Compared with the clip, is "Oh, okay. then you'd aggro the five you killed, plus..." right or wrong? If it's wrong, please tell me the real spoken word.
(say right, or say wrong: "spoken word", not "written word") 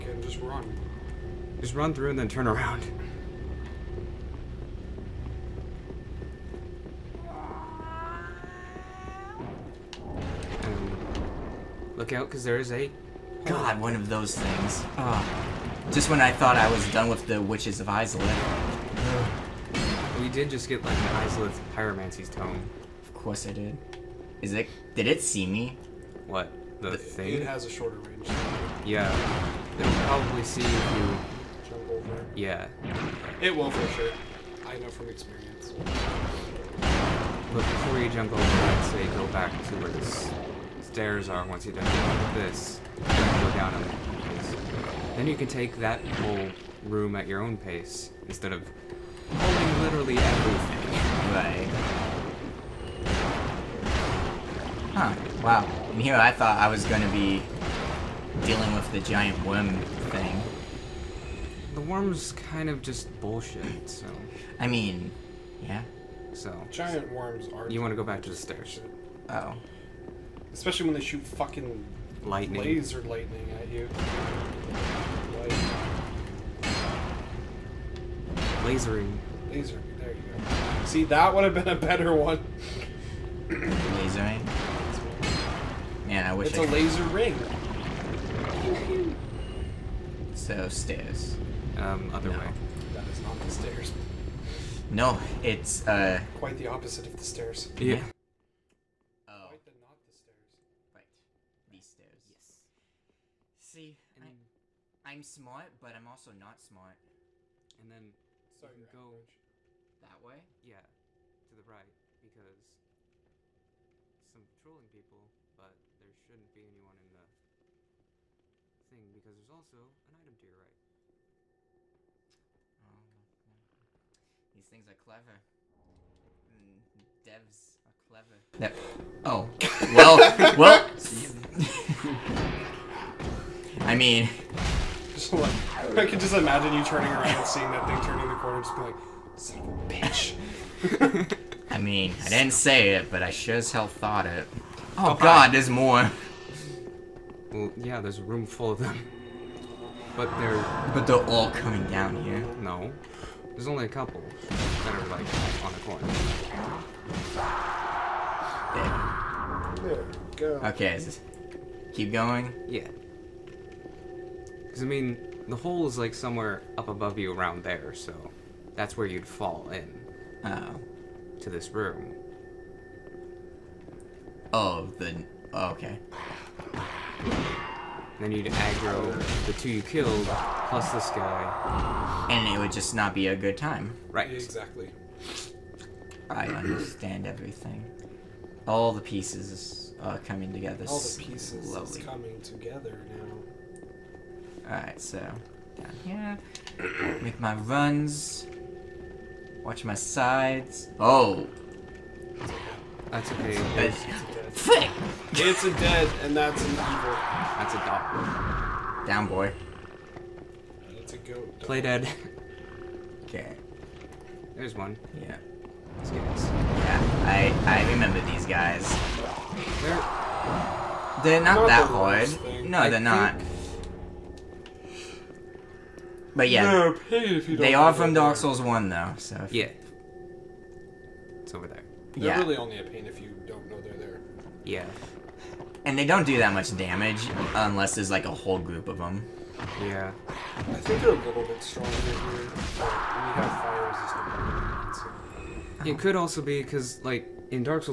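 wrong: "two", not "five".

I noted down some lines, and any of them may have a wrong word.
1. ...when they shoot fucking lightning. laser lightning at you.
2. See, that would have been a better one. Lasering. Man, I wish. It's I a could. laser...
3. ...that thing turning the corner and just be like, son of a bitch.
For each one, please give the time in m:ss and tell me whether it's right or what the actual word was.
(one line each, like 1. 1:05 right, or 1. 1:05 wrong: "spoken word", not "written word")
1. 1:10 right
2. 1:20 right
3. 2:17 right.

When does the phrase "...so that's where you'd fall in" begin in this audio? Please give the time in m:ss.
2:47.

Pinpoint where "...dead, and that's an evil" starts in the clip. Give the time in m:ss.
3:25.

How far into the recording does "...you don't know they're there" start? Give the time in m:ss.
3:53.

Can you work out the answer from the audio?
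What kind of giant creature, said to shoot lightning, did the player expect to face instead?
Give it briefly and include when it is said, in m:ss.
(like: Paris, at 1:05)
Giant worm, at 0:58.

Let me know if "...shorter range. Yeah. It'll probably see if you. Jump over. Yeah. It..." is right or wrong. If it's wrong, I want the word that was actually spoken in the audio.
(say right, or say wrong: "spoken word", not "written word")
right.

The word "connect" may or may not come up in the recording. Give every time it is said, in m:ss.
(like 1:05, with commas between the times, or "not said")
not said.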